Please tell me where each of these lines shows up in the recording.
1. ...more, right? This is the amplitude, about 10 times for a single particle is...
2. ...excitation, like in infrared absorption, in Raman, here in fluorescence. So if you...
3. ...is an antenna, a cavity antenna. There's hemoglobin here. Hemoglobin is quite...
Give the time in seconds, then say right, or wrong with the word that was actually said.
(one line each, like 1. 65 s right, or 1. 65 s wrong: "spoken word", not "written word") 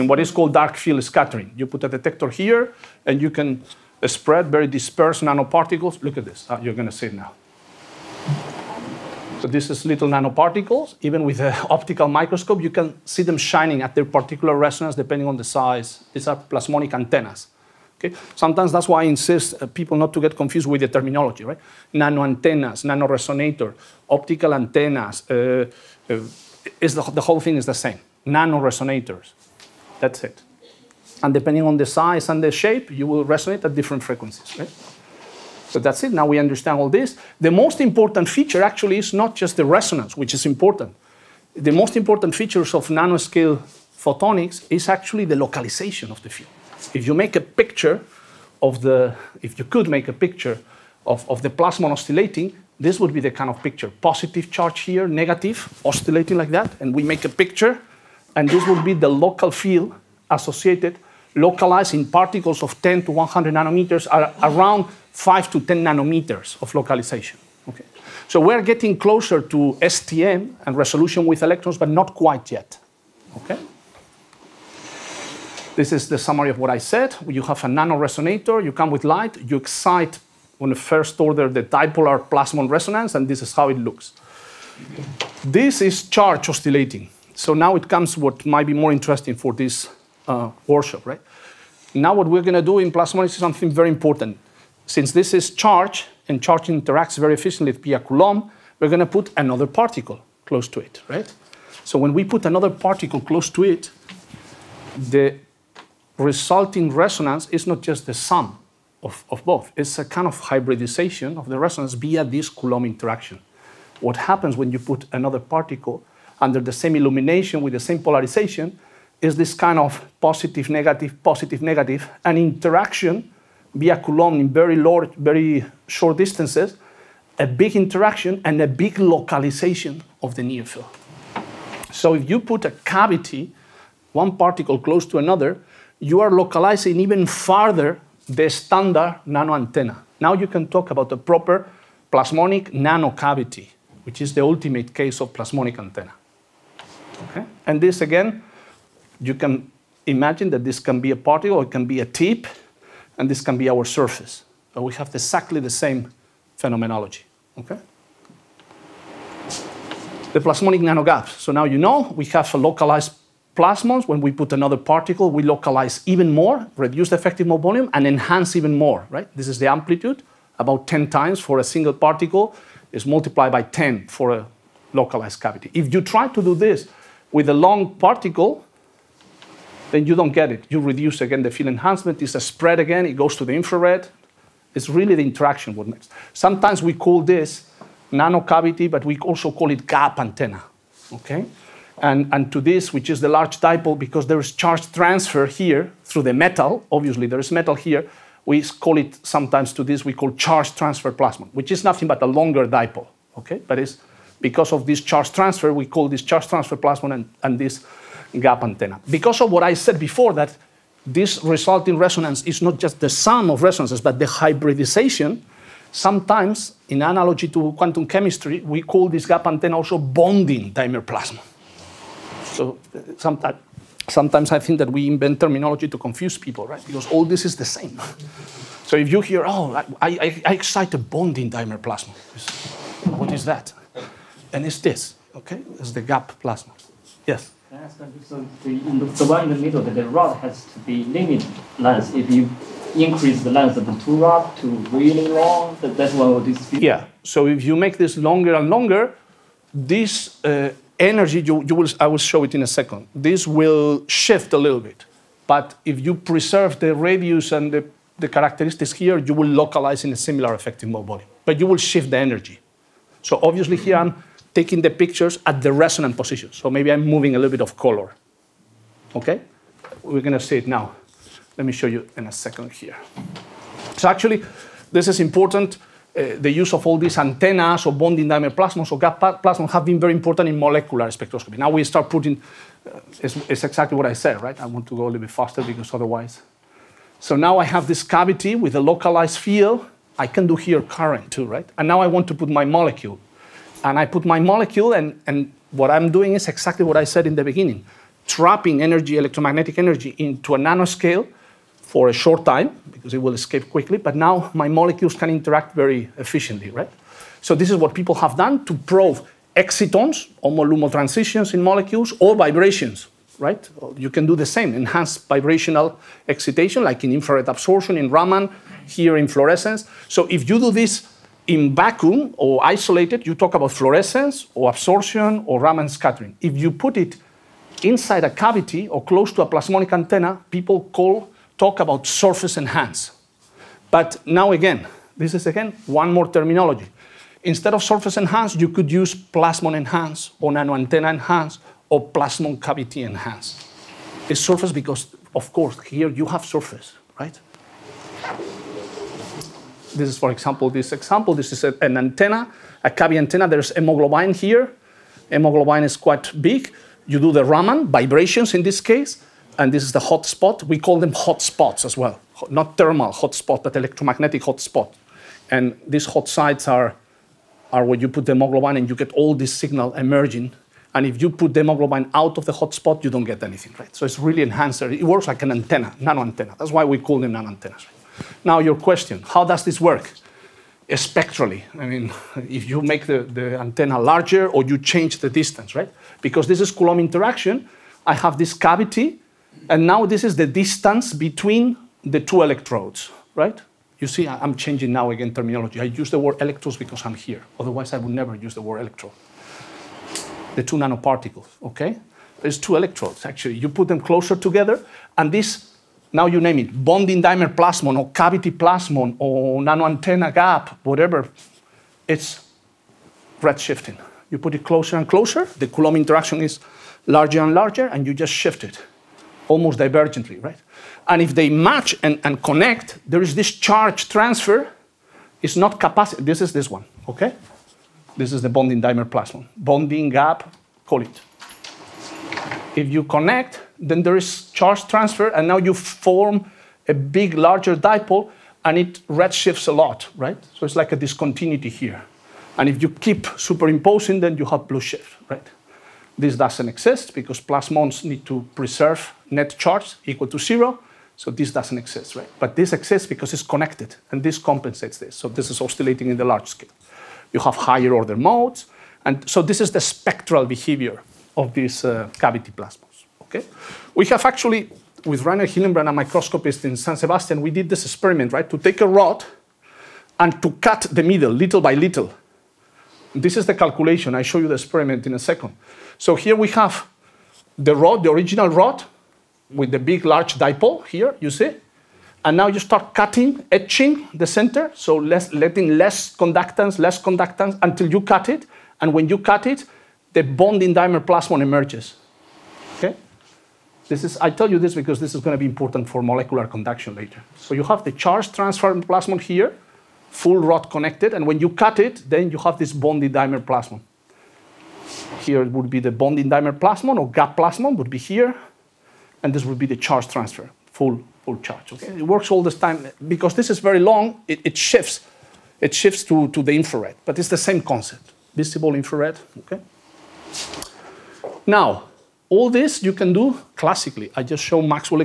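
1. 168 s right
2. 316 s right
3. 351 s right.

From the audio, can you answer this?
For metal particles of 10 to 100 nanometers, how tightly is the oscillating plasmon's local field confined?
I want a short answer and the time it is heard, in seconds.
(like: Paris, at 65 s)
5 to 10 nanometers, at 65 s.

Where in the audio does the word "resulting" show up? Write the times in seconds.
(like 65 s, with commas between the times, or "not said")
106 s, 211 s.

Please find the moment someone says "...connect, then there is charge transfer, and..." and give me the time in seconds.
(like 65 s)
433 s.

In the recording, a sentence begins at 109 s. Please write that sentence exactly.
It's a kind of hybridization of the resonance via this Coulomb interaction.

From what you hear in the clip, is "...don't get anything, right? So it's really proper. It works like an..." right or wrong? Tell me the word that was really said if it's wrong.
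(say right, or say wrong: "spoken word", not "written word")
wrong: "enhancer", not "proper".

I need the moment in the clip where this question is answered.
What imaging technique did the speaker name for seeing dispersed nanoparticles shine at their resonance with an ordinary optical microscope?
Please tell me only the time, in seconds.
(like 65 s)
0 s.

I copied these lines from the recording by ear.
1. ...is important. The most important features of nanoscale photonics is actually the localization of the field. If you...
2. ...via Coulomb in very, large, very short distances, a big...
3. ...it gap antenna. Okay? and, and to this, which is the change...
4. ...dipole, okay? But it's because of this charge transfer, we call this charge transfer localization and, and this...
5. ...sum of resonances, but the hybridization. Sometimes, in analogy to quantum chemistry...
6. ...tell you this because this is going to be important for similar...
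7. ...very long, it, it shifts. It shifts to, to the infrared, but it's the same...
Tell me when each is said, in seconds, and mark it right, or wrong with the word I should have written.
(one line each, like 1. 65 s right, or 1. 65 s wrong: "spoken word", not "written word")
1. 40 s right
2. 123 s right
3. 189 s wrong: "large", not "change"
4. 202 s wrong: "plasmon", not "localization"
5. 213 s right
6. 494 s wrong: "molecular", not "similar"
7. 513 s right.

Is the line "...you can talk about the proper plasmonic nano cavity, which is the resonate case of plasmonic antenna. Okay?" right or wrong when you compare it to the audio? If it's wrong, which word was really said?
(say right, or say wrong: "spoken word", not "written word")
wrong: "ultimate", not "resonate".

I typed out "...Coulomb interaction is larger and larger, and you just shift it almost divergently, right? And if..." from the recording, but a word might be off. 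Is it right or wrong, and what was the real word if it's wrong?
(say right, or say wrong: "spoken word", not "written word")
right.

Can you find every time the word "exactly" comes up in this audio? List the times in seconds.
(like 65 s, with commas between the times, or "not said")
155 s, 283 s, 296 s.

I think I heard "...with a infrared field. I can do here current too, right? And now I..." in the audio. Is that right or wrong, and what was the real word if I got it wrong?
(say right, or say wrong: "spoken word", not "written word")
wrong: "localized", not "infrared".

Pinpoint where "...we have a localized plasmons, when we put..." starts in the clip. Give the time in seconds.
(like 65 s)
162 s.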